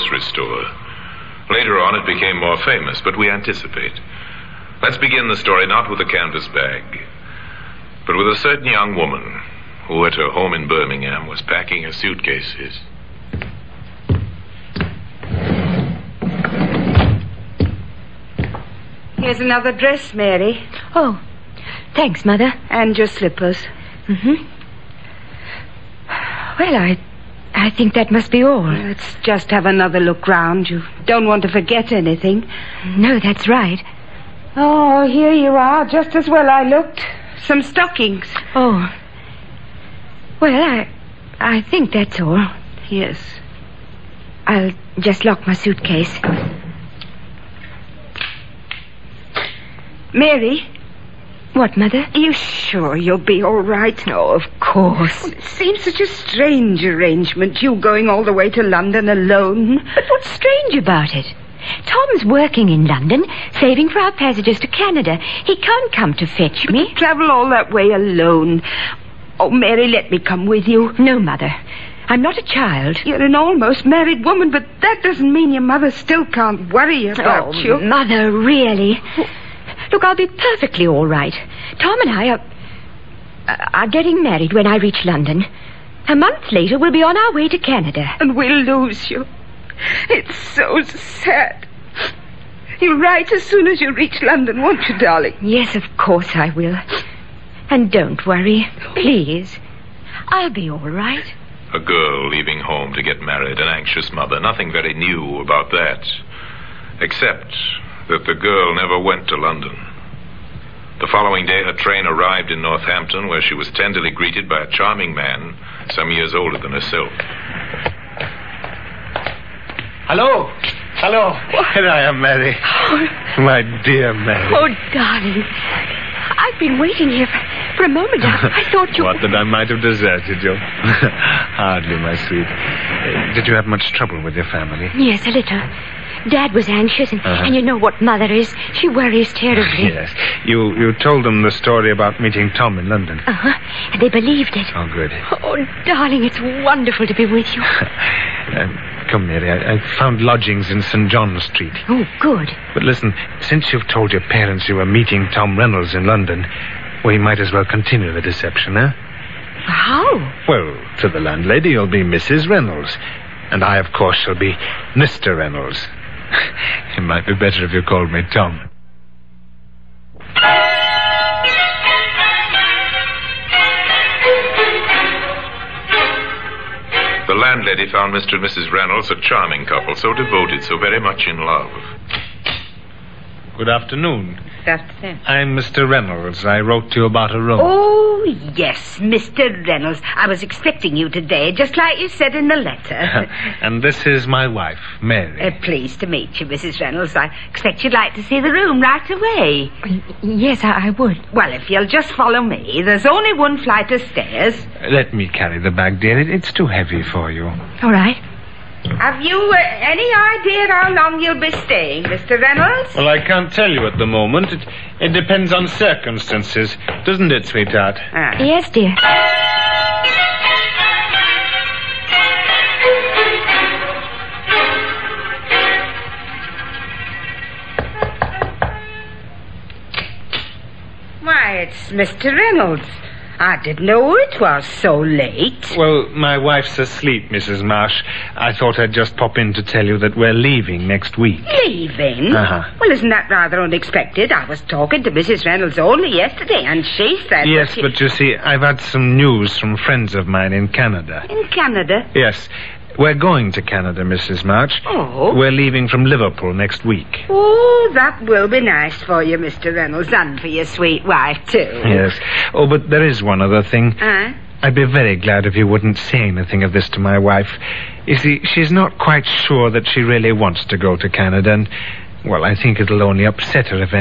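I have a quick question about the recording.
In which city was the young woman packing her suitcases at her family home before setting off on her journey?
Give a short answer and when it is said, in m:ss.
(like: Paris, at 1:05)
Birmingham, at 0:10.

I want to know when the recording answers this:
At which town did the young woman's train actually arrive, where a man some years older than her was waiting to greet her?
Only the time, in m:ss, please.
1:52.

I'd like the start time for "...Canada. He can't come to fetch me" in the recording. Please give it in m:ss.
1:04.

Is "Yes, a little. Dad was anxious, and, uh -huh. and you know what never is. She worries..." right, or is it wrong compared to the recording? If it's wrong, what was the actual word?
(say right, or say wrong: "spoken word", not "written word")
wrong: "mother", not "never".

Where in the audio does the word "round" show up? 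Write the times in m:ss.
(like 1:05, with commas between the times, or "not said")
0:30.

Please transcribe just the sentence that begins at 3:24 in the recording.
Let me carry the bag, dear.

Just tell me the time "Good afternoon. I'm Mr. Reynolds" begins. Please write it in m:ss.
3:03.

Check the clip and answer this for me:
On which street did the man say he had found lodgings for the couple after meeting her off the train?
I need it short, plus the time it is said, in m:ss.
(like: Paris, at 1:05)
St. John Street, at 2:30.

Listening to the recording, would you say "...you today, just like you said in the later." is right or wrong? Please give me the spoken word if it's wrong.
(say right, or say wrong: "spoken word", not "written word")
wrong: "letter", not "later".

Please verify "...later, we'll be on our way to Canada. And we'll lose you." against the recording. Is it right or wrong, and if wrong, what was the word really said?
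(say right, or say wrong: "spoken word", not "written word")
right.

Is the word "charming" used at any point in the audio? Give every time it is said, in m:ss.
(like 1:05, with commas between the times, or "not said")
1:54, 2:59.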